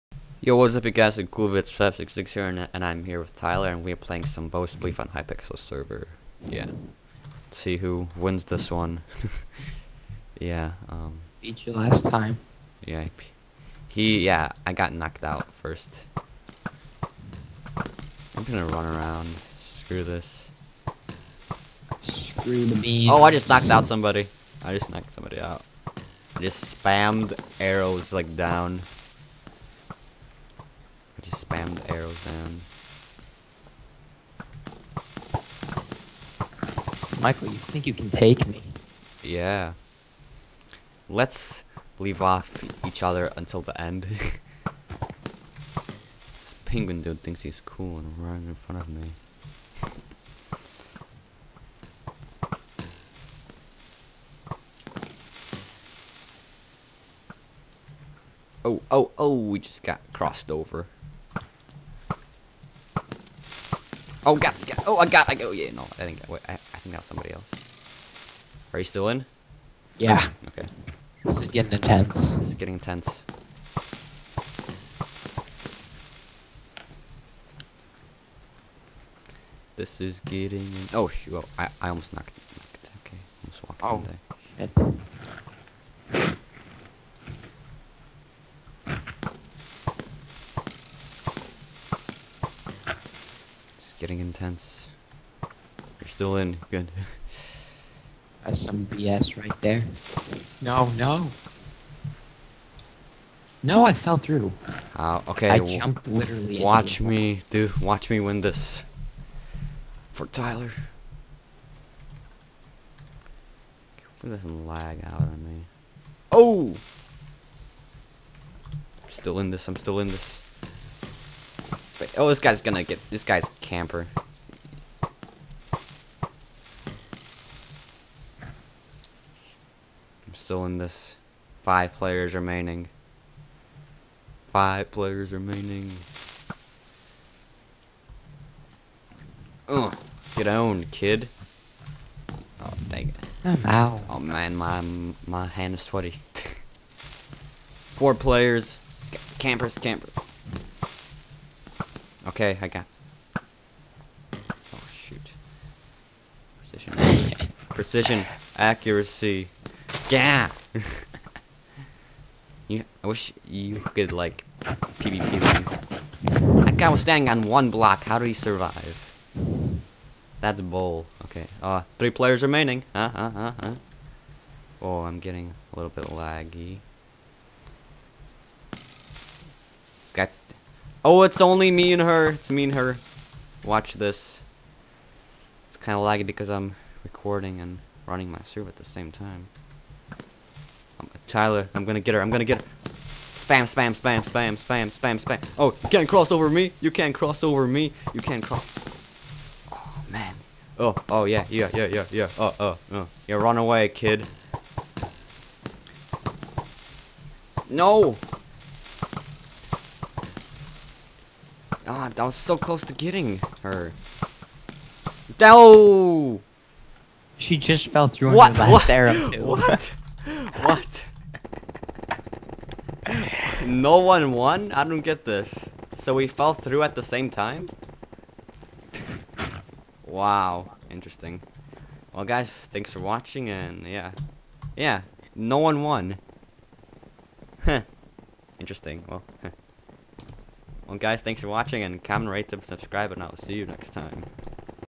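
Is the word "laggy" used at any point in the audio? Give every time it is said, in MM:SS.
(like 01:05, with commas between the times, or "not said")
02:56, 03:06.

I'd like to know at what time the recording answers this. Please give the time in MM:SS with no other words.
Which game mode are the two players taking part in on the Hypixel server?
00:04.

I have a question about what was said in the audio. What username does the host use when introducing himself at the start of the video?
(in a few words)
Coolvids566.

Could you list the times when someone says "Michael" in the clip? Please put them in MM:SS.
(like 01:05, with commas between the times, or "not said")
00:37.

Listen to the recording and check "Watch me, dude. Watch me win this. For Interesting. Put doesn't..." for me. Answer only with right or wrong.
wrong.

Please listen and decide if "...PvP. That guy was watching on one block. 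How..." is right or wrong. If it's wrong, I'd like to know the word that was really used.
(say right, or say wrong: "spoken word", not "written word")
wrong: "standing", not "watching".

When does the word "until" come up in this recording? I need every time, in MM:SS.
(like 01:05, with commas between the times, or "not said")
00:43.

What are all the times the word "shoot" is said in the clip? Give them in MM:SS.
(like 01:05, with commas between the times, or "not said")
01:21, 02:34.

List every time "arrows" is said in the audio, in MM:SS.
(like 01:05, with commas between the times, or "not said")
00:27, 00:31, 03:38.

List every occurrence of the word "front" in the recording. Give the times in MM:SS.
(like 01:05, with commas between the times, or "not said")
00:48.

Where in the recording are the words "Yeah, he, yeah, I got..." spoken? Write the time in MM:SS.
00:12.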